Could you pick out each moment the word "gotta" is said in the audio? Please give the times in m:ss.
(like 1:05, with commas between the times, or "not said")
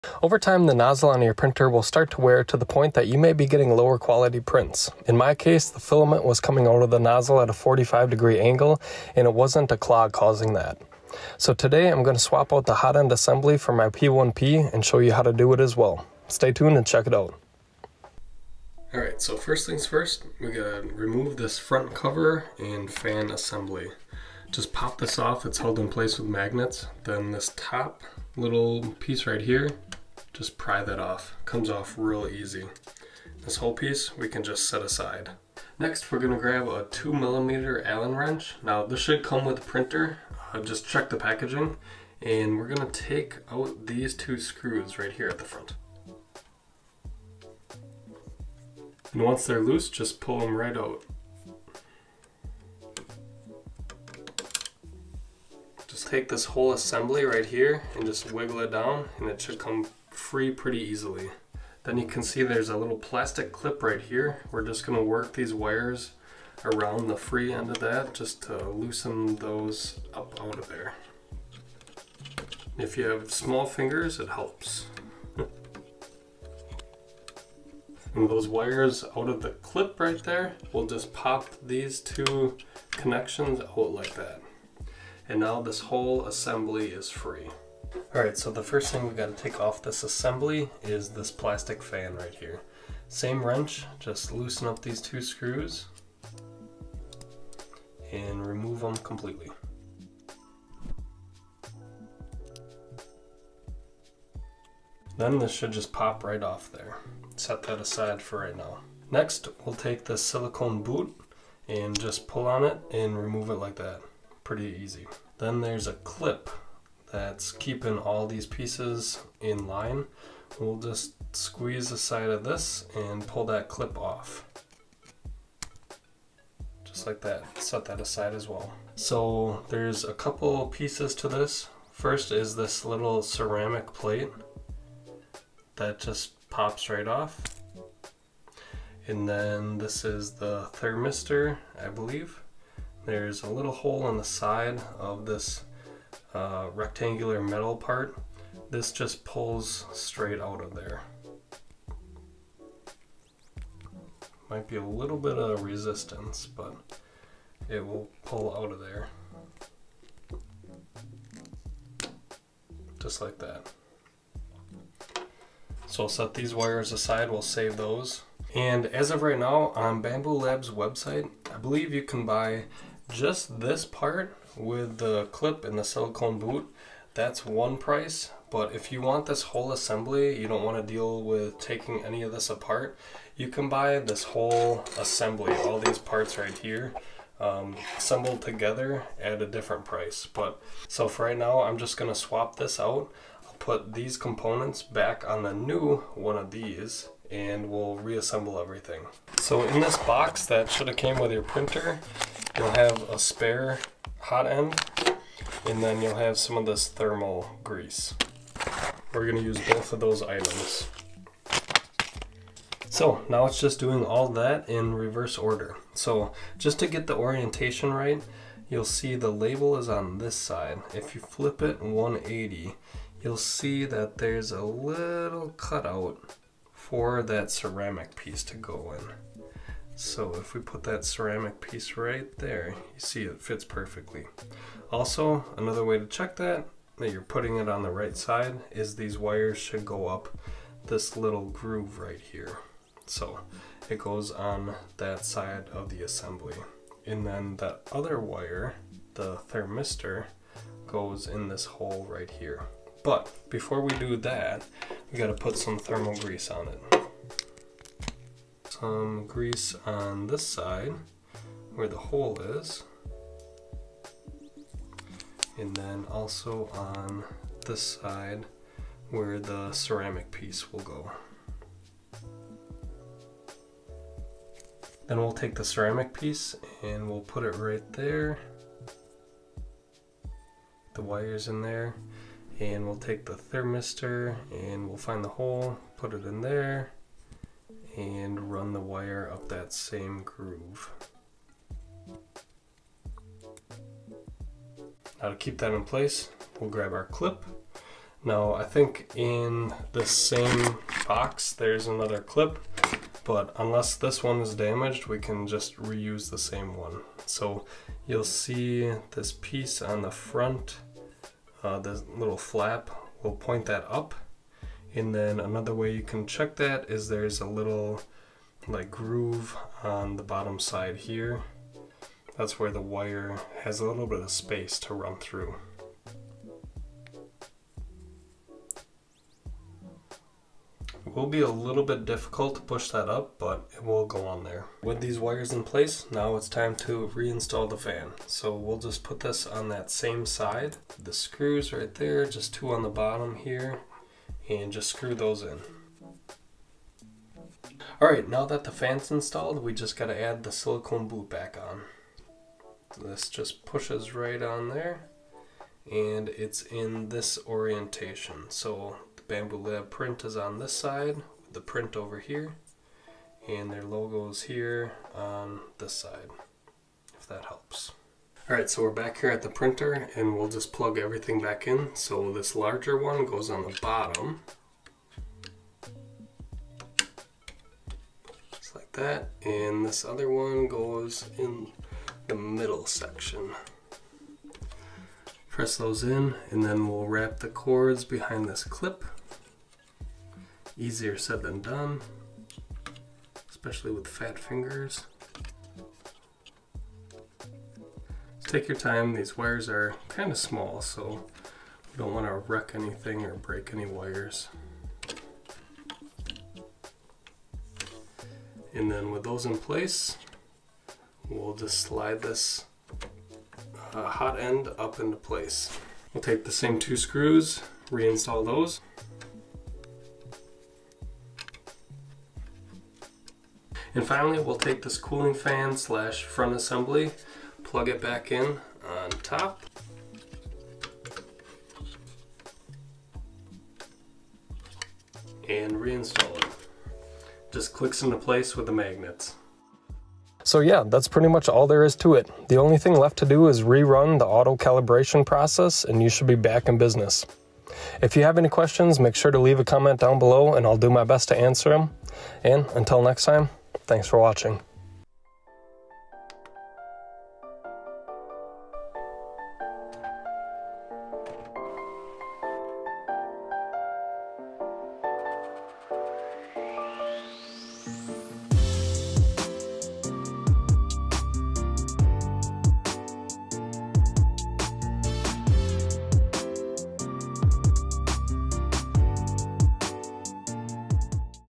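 0:20, 4:15.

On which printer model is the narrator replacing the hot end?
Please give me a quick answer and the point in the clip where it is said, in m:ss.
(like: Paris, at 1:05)
P1P, at 0:13.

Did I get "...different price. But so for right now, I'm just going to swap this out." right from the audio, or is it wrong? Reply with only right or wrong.
right.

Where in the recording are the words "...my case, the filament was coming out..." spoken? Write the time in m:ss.
0:05.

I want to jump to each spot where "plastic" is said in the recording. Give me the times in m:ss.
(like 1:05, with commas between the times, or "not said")
1:02, 1:31.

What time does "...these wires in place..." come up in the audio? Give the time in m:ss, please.
5:35.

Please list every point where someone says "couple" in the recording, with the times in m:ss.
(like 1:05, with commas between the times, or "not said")
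2:10.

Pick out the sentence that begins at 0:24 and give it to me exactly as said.
Just pop this off, it's held in place with magnets.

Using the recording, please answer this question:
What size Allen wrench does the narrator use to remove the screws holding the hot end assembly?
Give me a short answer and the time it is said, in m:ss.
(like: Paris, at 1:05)
2 millimeter, at 0:36.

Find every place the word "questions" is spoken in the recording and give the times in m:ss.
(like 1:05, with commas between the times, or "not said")
7:28.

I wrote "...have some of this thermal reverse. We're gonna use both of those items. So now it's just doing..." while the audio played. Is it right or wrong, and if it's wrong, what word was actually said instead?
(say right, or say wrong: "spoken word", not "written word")
wrong: "grease", not "reverse".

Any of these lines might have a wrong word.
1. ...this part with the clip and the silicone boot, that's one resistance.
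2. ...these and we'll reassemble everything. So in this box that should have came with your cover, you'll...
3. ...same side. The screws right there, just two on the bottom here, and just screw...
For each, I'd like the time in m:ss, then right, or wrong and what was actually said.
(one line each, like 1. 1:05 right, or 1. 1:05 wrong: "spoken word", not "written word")
1. 2:53 wrong: "price", not "resistance"
2. 3:16 wrong: "printer", not "cover"
3. 5:39 right.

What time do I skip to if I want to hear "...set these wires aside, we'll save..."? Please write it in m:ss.
2:46.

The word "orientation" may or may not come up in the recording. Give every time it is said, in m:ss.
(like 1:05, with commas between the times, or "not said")
3:37, 5:57.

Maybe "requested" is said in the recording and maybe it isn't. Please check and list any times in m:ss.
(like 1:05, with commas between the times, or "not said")
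not said.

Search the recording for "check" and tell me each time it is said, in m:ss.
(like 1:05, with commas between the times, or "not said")
0:16, 0:40, 3:56, 5:16.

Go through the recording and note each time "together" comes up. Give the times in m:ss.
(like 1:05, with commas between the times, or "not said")
3:08.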